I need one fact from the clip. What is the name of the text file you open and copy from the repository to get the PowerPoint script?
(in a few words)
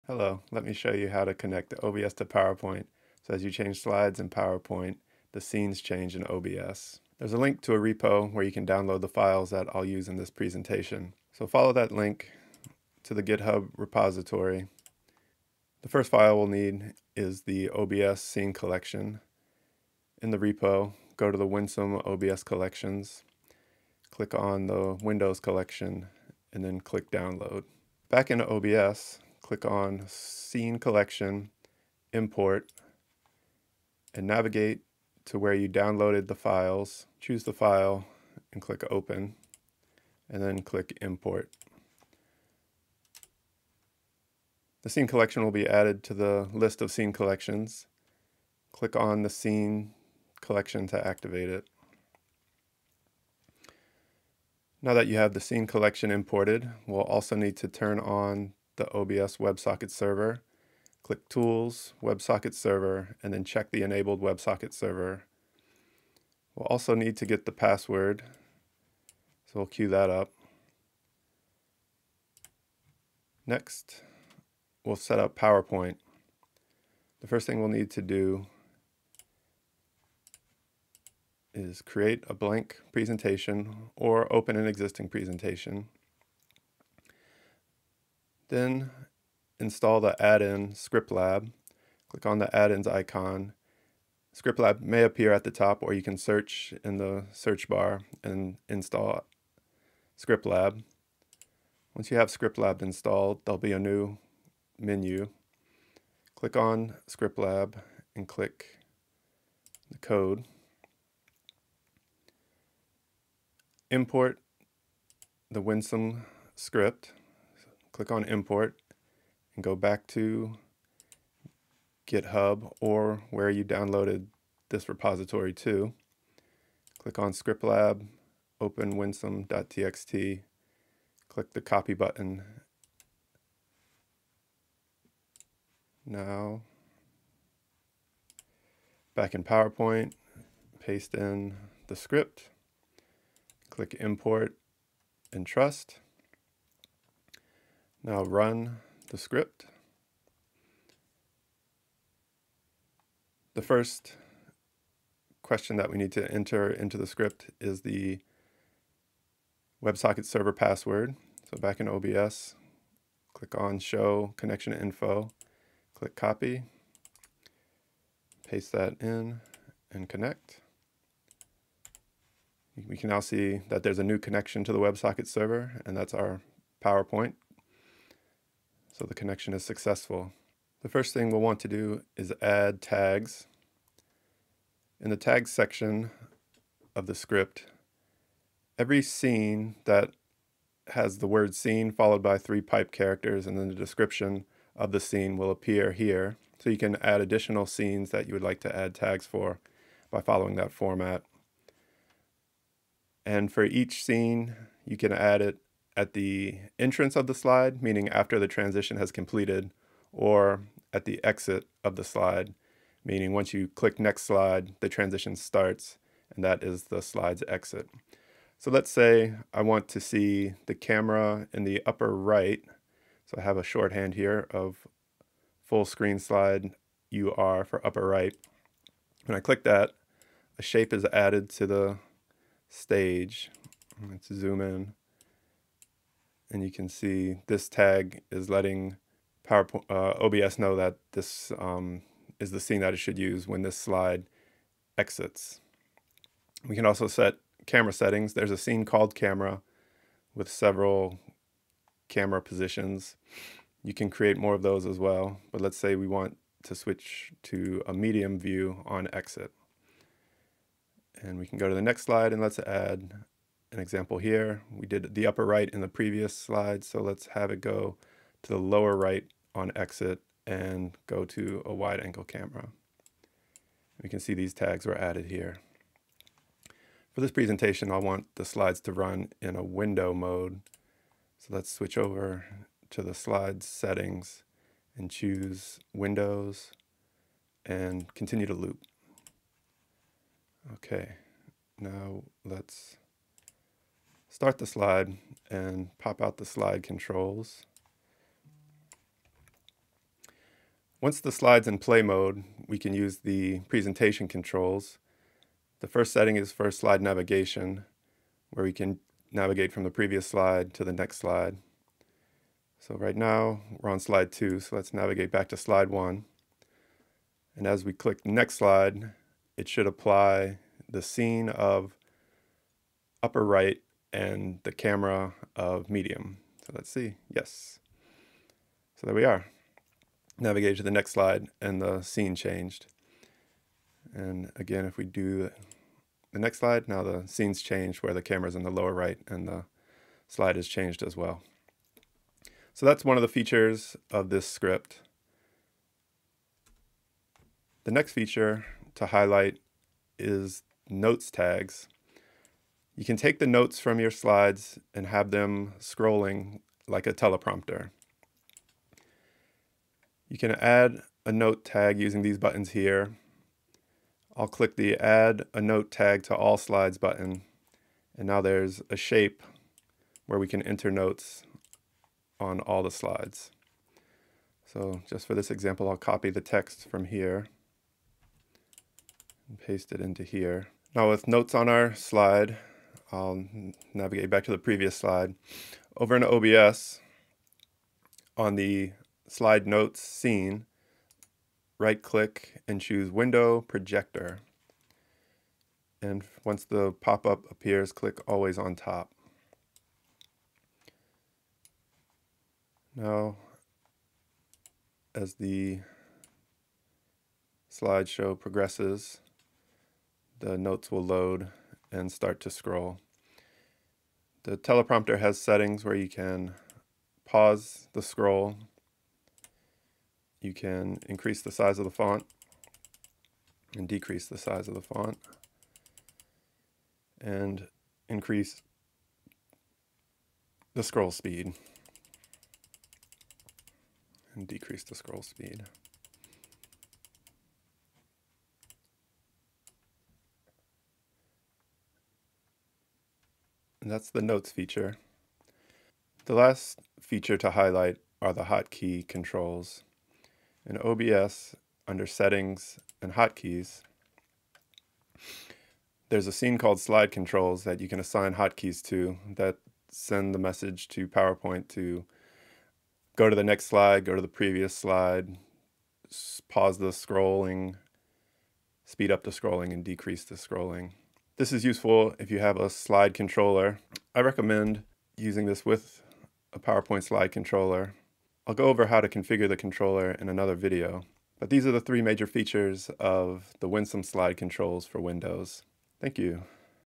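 winsome.txt.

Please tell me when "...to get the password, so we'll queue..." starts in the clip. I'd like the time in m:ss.
1:07.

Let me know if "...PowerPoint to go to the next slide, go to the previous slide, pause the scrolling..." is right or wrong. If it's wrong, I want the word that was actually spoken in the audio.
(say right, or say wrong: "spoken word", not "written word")
right.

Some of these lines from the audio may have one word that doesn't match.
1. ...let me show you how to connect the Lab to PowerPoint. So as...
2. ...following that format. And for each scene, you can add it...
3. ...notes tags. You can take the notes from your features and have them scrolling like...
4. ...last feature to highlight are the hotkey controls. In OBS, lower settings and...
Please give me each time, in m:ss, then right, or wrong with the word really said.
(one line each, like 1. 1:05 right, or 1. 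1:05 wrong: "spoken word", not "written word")
1. 0:00 wrong: "OBS", not "Lab"
2. 3:20 right
3. 5:50 wrong: "slides", not "features"
4. 7:26 wrong: "under", not "lower".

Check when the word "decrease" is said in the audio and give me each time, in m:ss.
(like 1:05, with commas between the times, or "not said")
7:03, 7:14, 7:49.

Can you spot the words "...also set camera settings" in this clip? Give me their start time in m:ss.
4:06.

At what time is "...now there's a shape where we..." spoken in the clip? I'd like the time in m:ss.
6:08.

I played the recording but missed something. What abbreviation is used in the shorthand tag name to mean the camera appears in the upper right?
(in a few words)
UR.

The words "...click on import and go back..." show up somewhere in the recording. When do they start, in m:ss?
1:58.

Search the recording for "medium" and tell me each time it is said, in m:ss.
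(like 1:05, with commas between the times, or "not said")
4:17, 5:25.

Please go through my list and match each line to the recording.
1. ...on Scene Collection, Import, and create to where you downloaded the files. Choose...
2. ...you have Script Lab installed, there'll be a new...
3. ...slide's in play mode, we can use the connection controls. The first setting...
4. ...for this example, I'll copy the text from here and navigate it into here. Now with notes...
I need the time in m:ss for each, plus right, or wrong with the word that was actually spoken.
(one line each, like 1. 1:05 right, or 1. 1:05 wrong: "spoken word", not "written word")
1. 0:29 wrong: "navigate", not "create"
2. 1:42 right
3. 5:01 wrong: "presentation", not "connection"
4. 6:15 wrong: "paste", not "navigate".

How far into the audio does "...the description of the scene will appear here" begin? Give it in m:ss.
3:13.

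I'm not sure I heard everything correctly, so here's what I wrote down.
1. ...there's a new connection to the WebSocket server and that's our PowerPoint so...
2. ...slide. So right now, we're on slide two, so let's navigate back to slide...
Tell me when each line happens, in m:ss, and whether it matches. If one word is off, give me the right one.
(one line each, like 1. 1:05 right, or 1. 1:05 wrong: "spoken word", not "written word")
1. 2:53 right
2. 5:11 right.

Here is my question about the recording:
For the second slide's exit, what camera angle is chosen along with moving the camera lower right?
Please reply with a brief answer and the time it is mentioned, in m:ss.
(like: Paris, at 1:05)
wide angle, at 4:31.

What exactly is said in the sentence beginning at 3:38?
So let's say I want to see the camera in the upper right.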